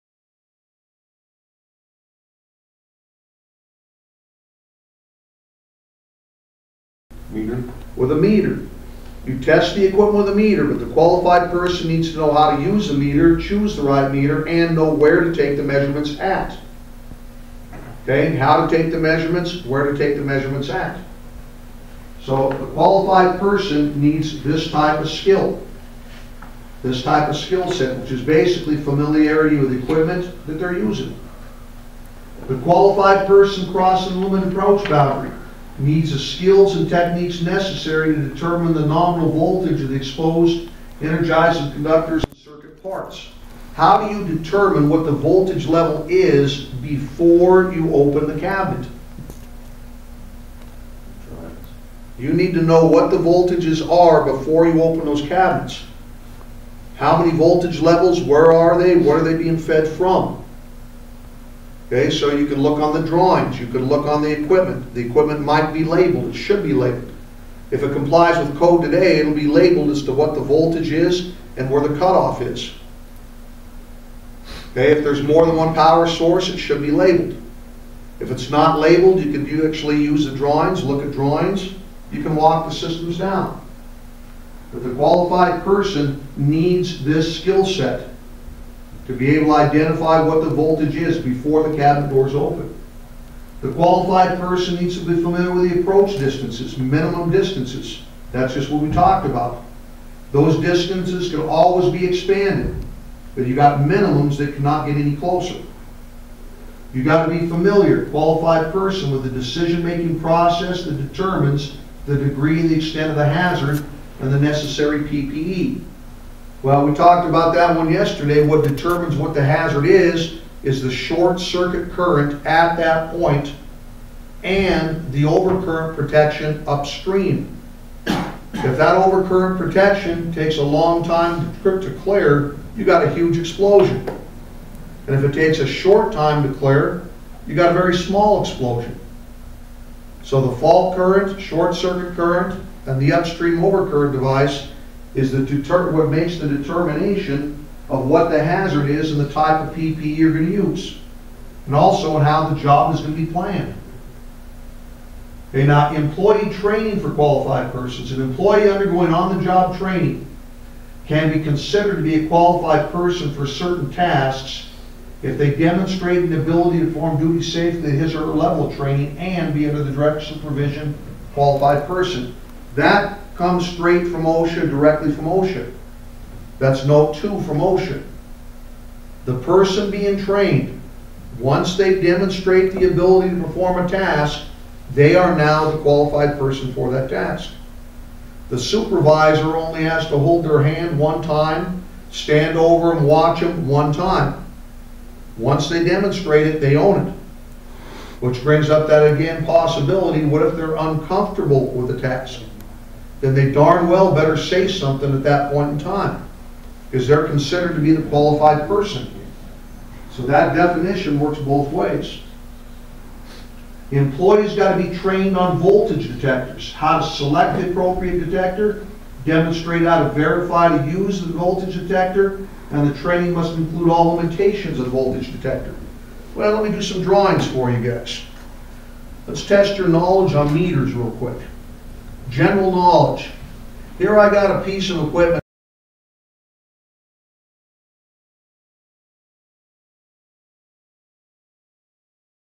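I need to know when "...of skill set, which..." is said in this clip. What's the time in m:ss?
0:27.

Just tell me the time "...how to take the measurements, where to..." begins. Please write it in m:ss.
0:18.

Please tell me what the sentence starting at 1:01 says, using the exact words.
Okay, so you can look on the drawings, you can look on the equipment.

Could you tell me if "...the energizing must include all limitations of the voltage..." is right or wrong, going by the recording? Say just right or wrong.
wrong.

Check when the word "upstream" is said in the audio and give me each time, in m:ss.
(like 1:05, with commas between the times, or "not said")
2:06, 2:23.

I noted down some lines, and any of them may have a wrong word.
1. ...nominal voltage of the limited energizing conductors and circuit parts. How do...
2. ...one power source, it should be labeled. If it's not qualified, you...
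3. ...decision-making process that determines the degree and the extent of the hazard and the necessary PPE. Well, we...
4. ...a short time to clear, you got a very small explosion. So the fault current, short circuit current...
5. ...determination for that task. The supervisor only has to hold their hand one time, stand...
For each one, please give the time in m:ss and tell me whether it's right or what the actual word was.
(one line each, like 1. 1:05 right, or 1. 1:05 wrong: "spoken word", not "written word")
1. 0:38 wrong: "exposed", not "limited"
2. 1:15 wrong: "labeled", not "qualified"
3. 1:49 right
4. 2:15 right
5. 3:06 wrong: "person", not "determination".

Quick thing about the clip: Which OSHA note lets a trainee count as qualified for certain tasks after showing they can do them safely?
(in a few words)
Note 2.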